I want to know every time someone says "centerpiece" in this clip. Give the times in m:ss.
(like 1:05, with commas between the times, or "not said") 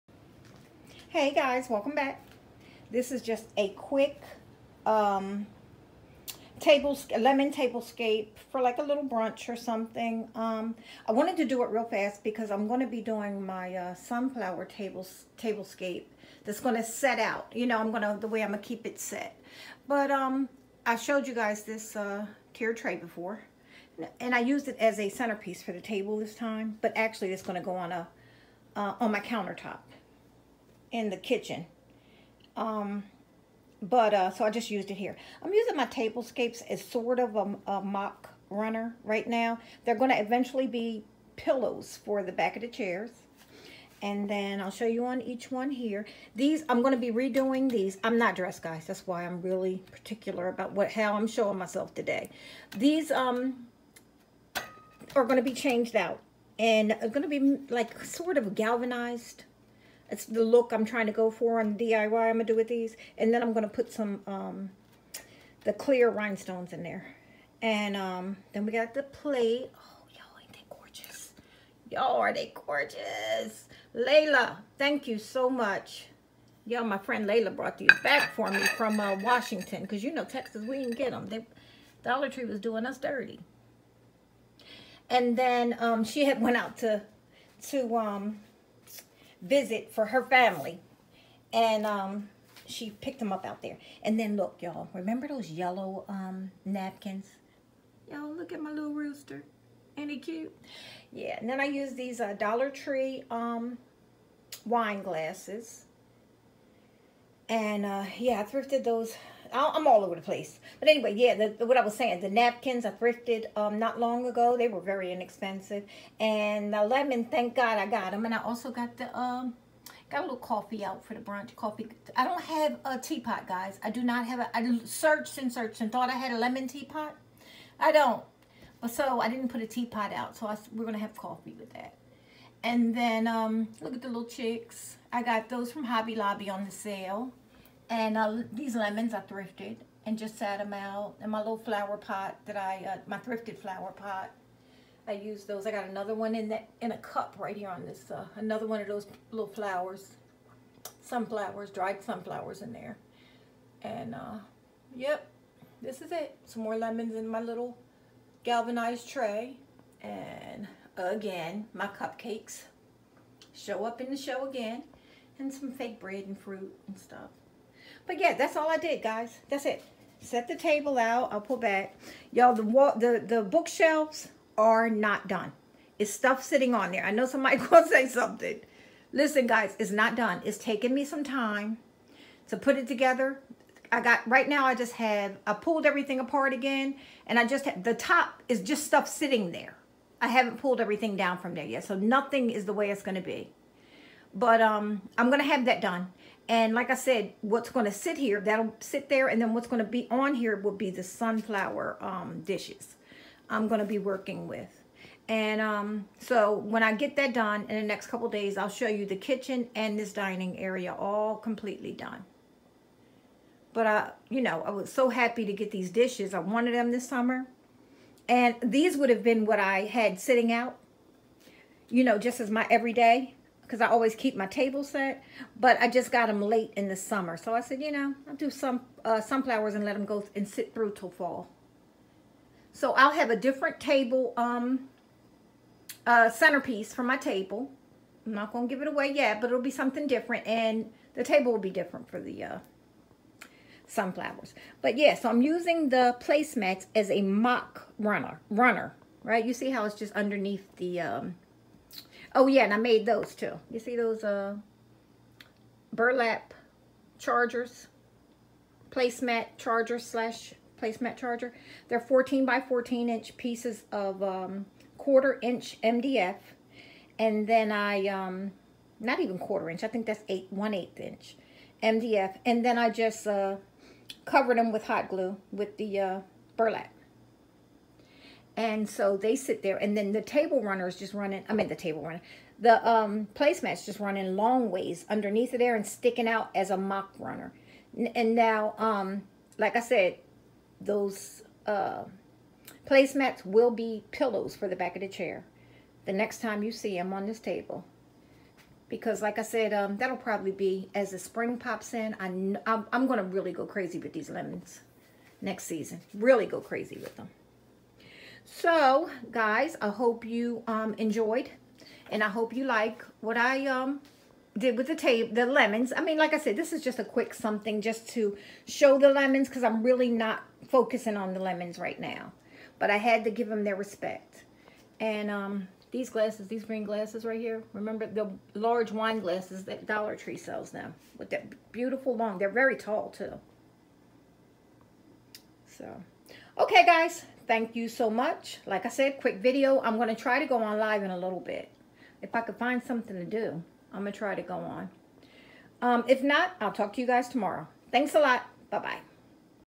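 0:25, 3:56.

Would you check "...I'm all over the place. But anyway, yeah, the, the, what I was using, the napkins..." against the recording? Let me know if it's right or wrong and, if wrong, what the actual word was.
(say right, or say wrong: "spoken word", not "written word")
wrong: "saying", not "using".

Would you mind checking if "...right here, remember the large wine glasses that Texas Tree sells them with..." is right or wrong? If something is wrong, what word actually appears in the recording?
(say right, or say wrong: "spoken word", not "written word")
wrong: "Dollar", not "Texas".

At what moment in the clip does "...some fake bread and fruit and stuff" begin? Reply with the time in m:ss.
2:45.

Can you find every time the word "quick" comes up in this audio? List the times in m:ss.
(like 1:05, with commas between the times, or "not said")
0:03, 5:17, 5:39.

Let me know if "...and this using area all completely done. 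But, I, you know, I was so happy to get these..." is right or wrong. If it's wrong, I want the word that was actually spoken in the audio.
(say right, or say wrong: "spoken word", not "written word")
wrong: "dining", not "using".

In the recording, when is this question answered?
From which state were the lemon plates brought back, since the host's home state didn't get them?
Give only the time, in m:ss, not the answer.
1:19.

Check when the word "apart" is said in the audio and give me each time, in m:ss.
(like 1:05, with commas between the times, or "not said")
3:06.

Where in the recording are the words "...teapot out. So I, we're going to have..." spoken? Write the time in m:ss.
2:09.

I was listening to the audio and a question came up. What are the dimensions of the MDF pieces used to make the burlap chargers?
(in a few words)
14 by 14 inch.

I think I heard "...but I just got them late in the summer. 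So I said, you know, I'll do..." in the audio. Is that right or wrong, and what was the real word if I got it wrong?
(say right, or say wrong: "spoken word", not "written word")
right.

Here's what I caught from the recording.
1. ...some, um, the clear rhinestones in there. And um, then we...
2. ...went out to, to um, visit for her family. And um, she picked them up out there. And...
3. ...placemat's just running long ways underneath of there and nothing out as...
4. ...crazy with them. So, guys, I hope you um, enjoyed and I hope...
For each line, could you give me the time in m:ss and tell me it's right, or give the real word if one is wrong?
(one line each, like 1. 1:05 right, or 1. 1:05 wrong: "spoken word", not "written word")
1. 1:03 right
2. 1:26 right
3. 4:43 wrong: "sticking", not "nothing"
4. 5:06 right.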